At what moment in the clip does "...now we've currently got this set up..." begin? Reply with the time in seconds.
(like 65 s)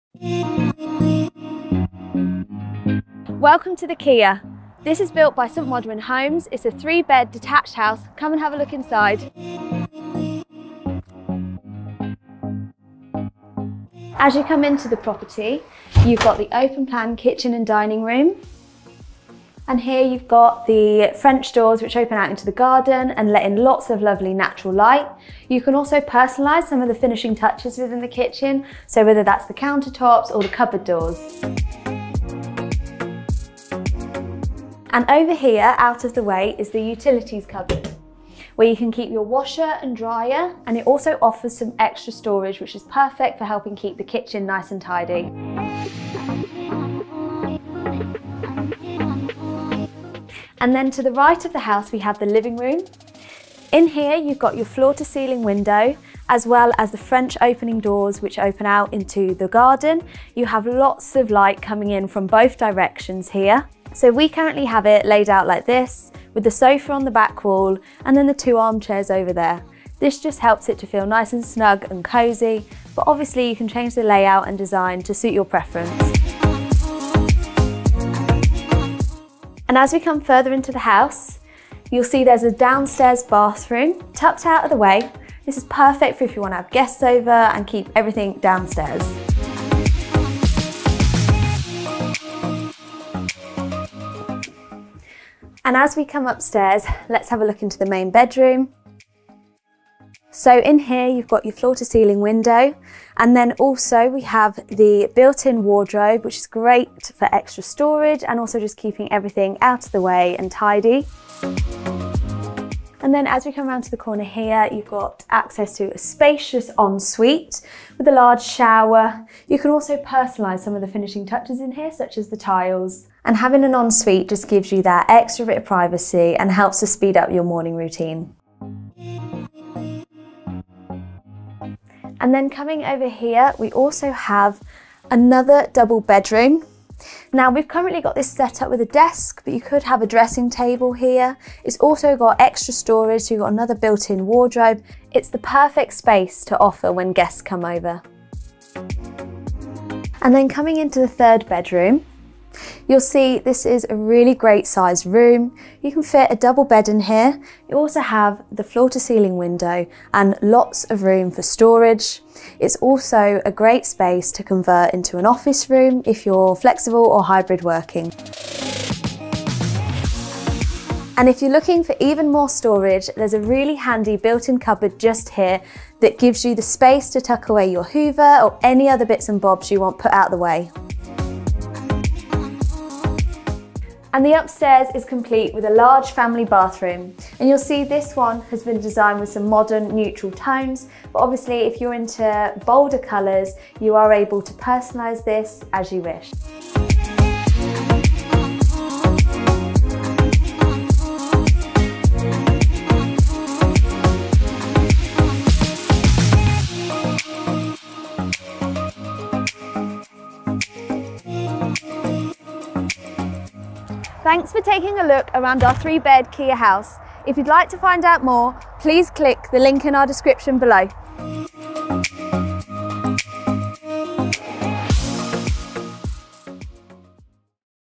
137 s.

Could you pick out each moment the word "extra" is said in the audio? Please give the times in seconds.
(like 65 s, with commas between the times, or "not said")
41 s, 107 s, 125 s, 142 s.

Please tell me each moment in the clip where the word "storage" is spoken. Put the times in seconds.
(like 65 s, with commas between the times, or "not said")
42 s, 107 s, 142 s, 161 s, 172 s.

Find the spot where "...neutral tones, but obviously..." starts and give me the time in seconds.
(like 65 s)
189 s.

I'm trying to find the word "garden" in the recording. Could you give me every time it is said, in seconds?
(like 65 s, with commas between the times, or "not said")
22 s, 59 s.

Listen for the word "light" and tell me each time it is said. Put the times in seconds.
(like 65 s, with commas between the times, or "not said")
24 s, 61 s.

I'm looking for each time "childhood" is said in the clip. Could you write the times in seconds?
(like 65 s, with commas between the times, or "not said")
not said.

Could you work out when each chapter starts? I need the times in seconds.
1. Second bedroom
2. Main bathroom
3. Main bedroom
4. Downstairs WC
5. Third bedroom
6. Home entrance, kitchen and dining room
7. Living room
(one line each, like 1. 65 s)
1. 131 s
2. 183 s
3. 95 s
4. 79 s
5. 149 s
6. 13 s
7. 49 s.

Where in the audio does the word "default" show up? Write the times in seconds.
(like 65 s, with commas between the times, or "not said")
not said.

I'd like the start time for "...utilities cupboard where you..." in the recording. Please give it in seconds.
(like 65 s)
36 s.